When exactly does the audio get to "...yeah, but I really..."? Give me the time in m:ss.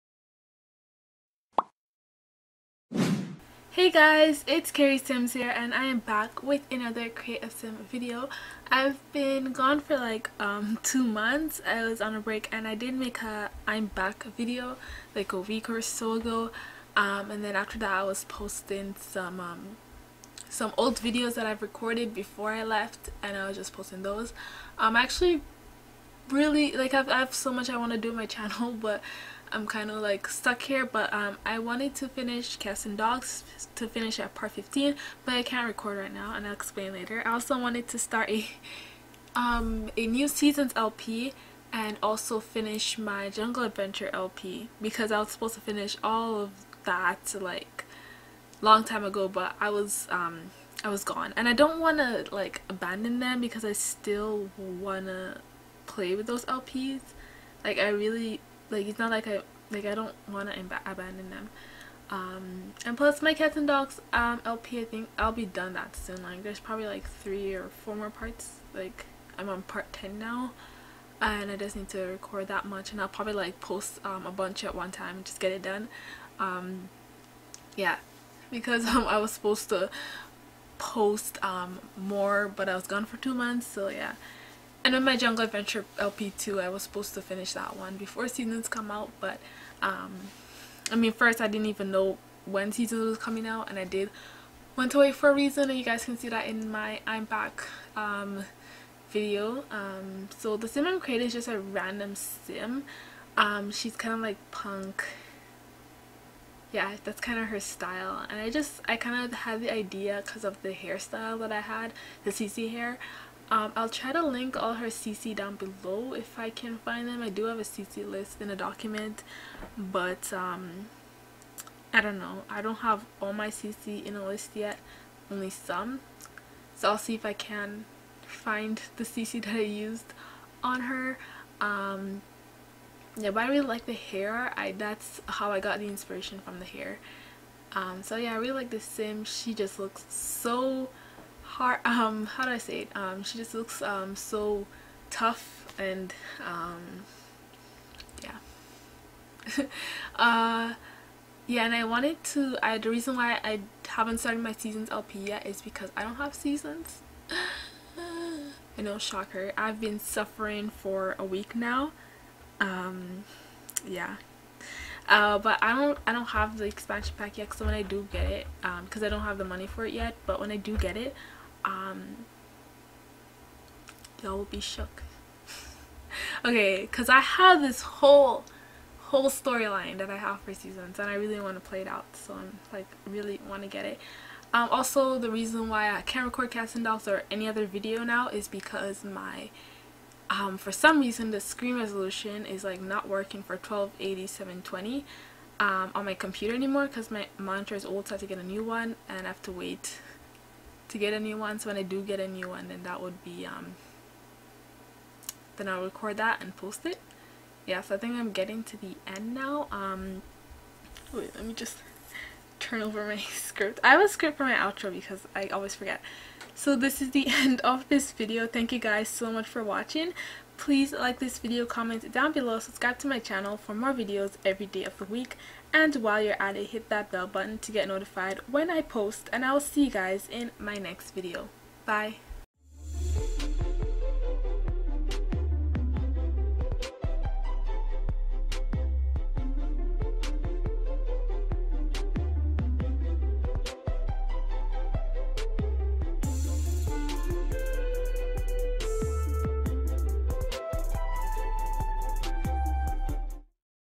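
2:13.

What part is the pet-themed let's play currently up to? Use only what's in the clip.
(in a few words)
10.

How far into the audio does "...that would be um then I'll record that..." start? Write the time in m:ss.
3:22.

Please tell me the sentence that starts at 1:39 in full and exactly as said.
Um, so the sim I'm creating is just a random sim.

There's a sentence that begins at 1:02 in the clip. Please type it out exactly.
Um, and plus my cats and dogs um, LP I think I'll be done that soon.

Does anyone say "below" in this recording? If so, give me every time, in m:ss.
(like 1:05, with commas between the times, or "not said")
1:55, 3:42.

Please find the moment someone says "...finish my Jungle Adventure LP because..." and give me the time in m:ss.
0:42.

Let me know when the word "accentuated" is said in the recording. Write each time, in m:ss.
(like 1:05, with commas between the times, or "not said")
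not said.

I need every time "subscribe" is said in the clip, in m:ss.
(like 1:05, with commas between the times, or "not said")
3:42.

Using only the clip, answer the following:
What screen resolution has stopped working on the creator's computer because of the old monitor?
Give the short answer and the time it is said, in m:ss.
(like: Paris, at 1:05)
1280 720, at 3:13.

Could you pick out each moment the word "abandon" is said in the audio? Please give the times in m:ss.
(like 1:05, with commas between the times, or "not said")
0:52, 1:00.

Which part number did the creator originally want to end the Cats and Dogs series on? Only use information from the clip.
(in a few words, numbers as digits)
15.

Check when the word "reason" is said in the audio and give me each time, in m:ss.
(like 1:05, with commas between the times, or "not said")
1:35, 2:32, 3:05, 3:11.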